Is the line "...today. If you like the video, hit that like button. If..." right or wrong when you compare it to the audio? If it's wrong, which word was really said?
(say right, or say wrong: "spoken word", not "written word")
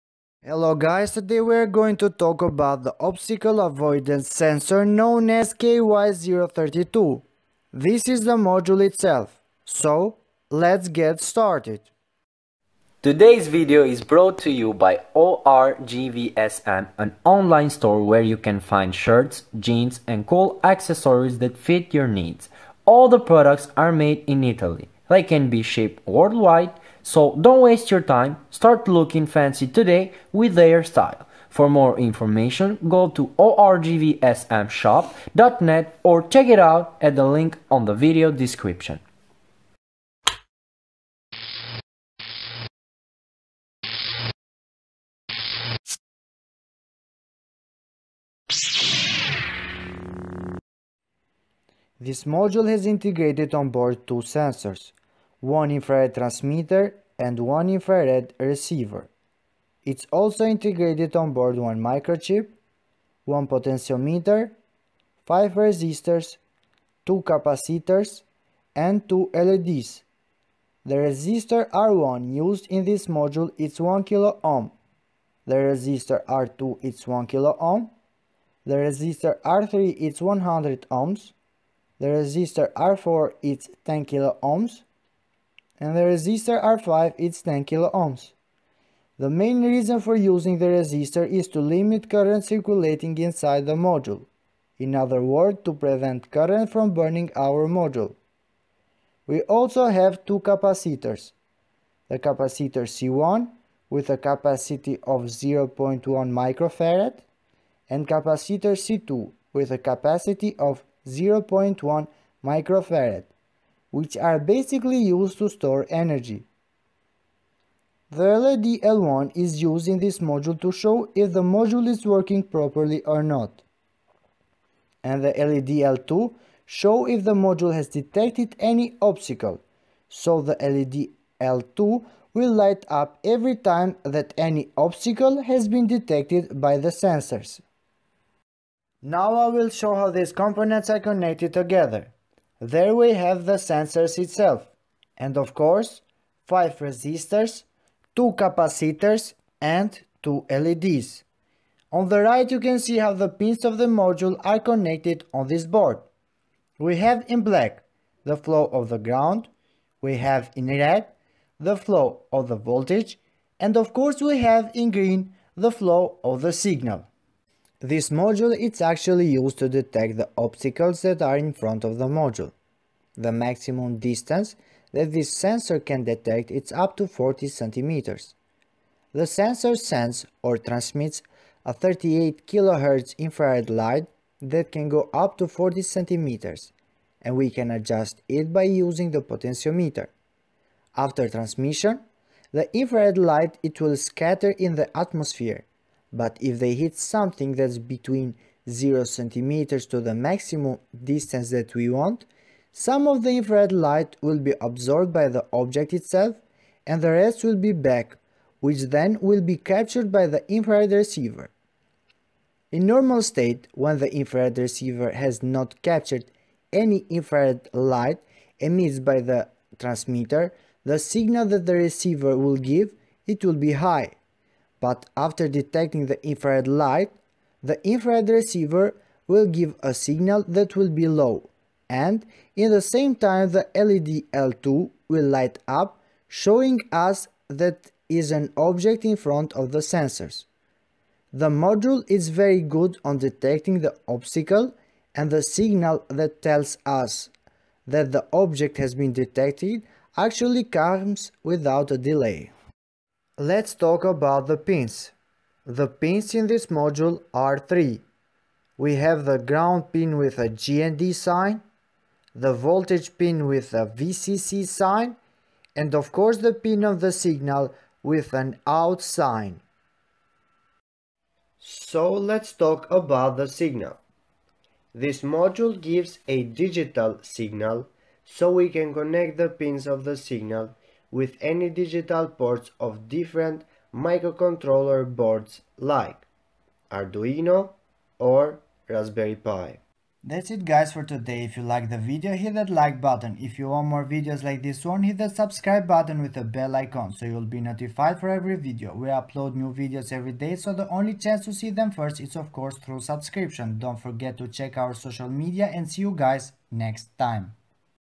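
right.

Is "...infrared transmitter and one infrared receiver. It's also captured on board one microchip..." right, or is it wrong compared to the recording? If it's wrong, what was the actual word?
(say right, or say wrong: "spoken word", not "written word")
wrong: "integrated", not "captured".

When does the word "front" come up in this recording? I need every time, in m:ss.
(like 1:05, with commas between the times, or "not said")
2:51, 3:59.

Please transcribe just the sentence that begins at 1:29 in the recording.
The main reason for using the resistor is to limit current circulating inside the module.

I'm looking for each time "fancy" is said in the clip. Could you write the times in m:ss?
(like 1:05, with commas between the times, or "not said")
0:29.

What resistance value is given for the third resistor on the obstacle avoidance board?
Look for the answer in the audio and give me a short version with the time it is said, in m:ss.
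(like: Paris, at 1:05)
100 ohms, at 1:20.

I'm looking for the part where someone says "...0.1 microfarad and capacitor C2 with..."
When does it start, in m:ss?
1:45.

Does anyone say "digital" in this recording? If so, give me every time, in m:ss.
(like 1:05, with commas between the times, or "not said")
4:36, 4:41.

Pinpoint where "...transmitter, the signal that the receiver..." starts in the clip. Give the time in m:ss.
3:39.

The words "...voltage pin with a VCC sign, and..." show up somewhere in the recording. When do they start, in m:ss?
4:22.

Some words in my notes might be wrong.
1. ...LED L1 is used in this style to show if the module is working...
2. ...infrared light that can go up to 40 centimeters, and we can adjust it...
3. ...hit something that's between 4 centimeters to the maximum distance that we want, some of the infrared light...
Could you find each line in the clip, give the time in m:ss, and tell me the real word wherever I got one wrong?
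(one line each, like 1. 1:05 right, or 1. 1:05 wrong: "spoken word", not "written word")
1. 1:58 wrong: "module", not "style"
2. 3:03 right
3. 3:16 wrong: "0", not "4".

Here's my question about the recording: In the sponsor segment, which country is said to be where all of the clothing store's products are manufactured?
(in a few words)
Italy.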